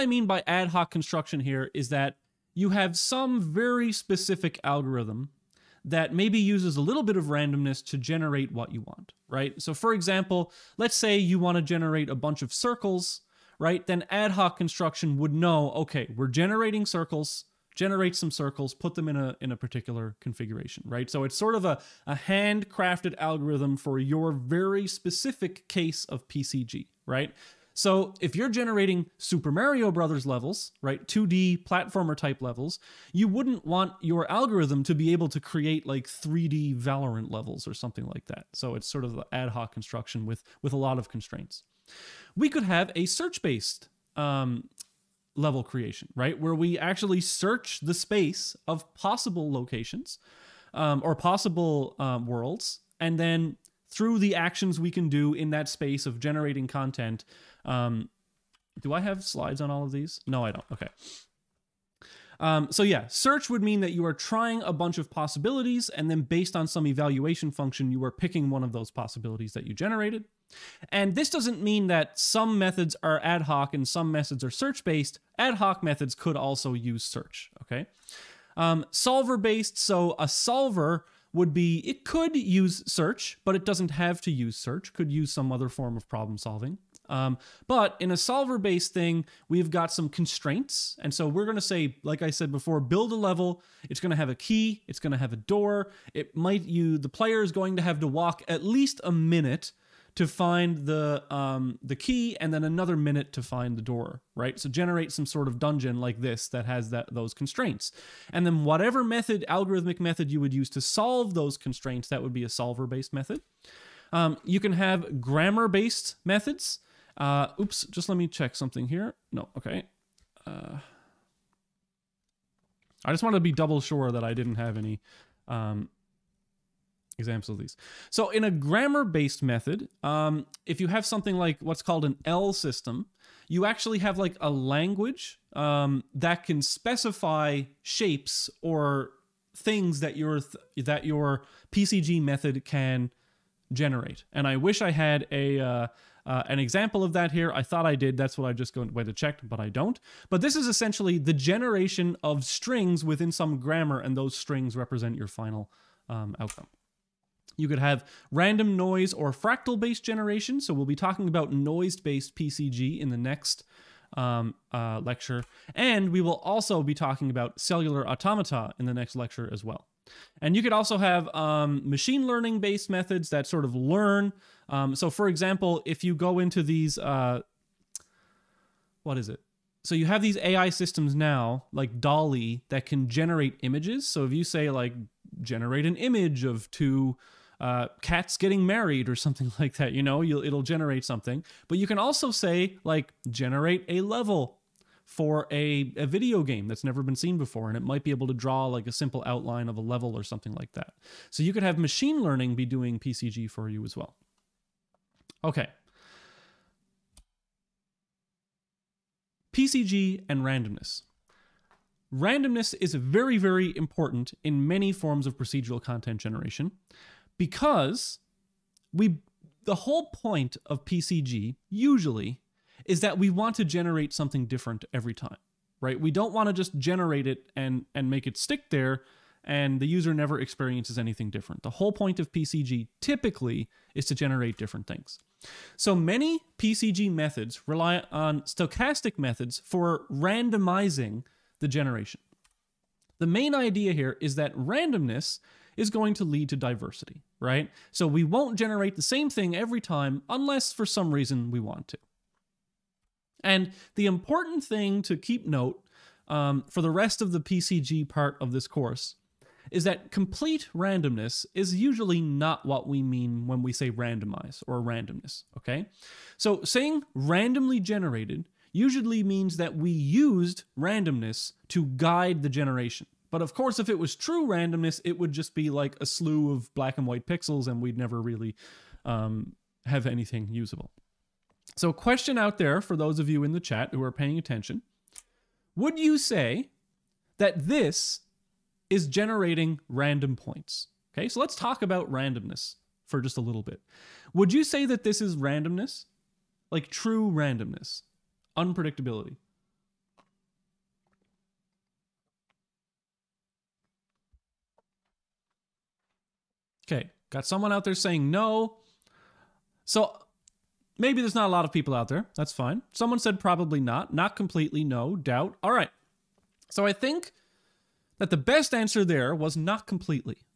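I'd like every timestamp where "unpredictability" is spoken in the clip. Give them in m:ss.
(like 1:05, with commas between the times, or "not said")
4:58.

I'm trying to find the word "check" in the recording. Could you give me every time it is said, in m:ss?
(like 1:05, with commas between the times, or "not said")
1:58, 2:29.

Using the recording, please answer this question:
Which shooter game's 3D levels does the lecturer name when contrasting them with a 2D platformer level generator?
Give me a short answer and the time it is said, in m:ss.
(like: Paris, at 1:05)
Valorant, at 0:36.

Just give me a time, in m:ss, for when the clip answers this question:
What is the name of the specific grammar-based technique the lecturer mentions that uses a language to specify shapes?
2:12.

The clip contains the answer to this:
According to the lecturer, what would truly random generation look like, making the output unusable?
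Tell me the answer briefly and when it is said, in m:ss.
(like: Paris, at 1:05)
black and white pixels, at 4:36.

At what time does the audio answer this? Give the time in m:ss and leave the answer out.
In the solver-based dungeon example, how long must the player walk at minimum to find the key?
1:39.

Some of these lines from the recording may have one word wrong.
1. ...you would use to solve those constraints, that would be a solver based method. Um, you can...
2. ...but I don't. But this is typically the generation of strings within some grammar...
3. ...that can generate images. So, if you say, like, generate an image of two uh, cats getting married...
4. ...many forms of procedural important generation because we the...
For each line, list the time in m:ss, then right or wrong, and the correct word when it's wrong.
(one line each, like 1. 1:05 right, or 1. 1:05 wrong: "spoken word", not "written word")
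1. 1:50 right
2. 2:29 wrong: "essentially", not "typically"
3. 3:02 right
4. 3:34 wrong: "content", not "important".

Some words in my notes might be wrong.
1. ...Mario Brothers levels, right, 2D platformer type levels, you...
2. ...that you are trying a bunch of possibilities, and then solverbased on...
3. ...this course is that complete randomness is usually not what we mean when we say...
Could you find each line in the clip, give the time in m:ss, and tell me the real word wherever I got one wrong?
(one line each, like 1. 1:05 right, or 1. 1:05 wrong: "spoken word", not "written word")
1. 0:29 right
2. 1:03 wrong: "based", not "solverbased"
3. 4:18 right.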